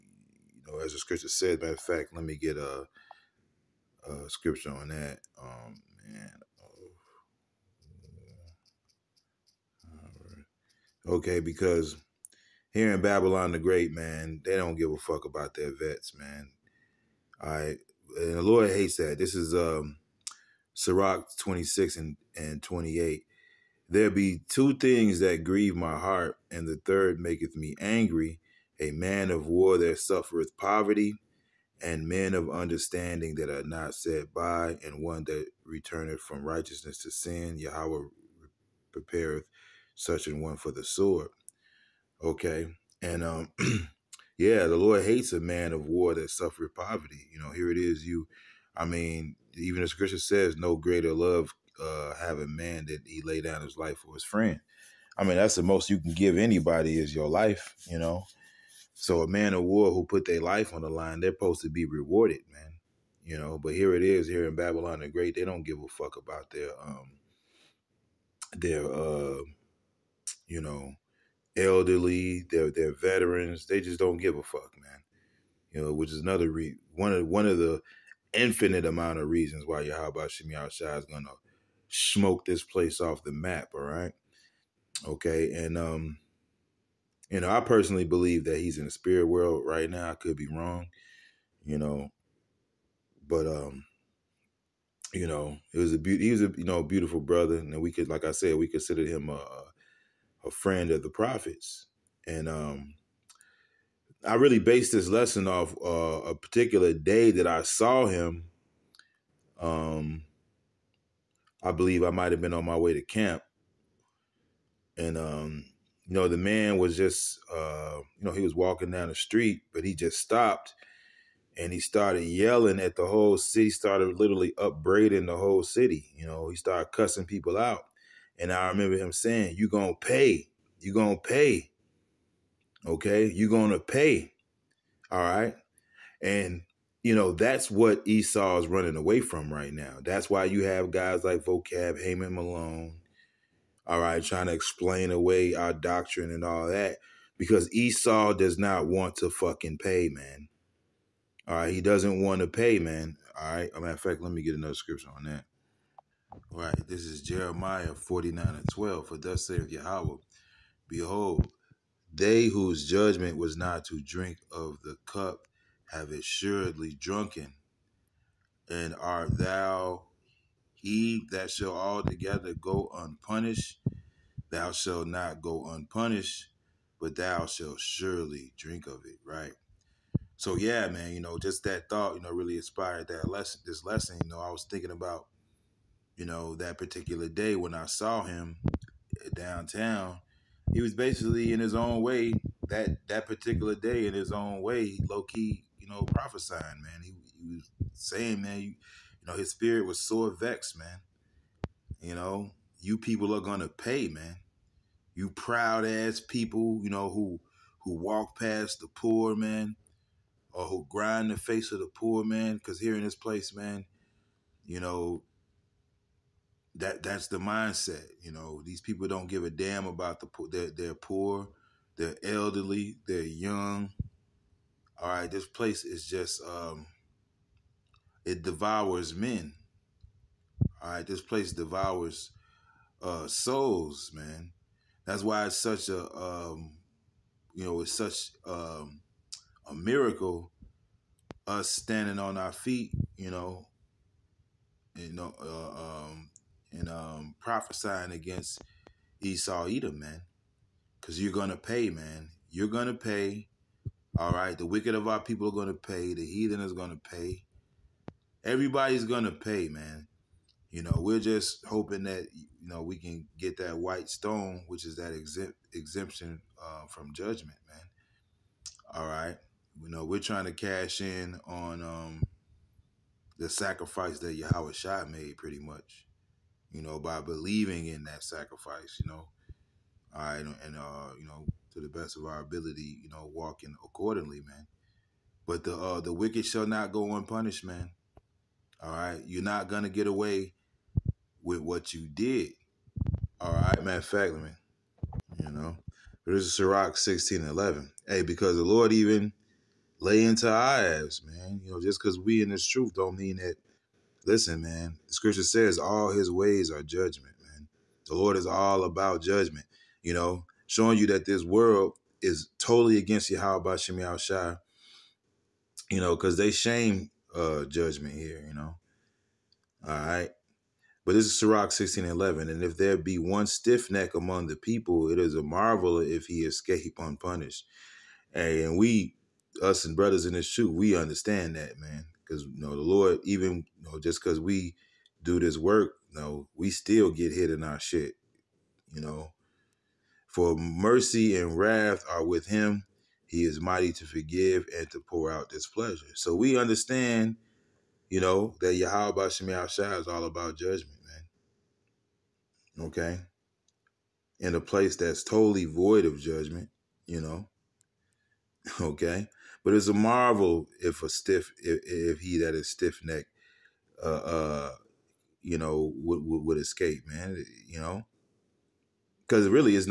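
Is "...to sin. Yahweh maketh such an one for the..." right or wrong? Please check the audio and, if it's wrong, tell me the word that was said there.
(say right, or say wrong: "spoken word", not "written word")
wrong: "prepareth", not "maketh".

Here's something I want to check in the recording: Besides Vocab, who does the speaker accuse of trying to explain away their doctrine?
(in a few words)
Heyman Malone.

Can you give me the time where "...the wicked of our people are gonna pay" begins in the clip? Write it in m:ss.
4:14.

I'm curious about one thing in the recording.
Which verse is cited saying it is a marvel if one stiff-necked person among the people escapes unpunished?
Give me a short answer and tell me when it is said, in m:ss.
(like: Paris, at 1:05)
Sirach 16:11, at 4:56.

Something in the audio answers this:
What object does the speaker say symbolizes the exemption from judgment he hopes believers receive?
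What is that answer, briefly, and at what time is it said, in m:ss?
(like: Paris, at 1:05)
white stone, at 4:23.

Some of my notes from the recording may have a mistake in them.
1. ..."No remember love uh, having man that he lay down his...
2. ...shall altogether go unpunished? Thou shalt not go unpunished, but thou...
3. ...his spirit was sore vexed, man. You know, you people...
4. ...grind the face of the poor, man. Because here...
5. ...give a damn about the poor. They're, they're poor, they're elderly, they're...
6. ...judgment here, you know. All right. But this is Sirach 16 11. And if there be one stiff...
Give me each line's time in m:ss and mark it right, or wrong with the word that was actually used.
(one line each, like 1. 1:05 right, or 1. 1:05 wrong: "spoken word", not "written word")
1. 0:50 wrong: "greater", not "remember"
2. 2:51 right
3. 3:19 right
4. 3:30 right
5. 3:39 right
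6. 5:17 right.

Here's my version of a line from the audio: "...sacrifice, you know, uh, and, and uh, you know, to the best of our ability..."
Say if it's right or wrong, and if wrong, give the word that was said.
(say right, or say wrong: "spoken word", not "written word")
right.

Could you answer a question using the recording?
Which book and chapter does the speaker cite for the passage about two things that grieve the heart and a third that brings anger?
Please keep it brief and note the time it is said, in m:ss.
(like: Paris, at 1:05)
Sirach 26, at 0:20.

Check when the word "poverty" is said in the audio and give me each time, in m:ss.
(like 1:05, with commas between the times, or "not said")
0:30, 0:46.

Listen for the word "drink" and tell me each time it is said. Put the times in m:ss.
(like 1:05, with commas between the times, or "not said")
2:44, 2:58.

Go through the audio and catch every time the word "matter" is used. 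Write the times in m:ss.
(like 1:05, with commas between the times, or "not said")
0:01, 2:33, 4:53.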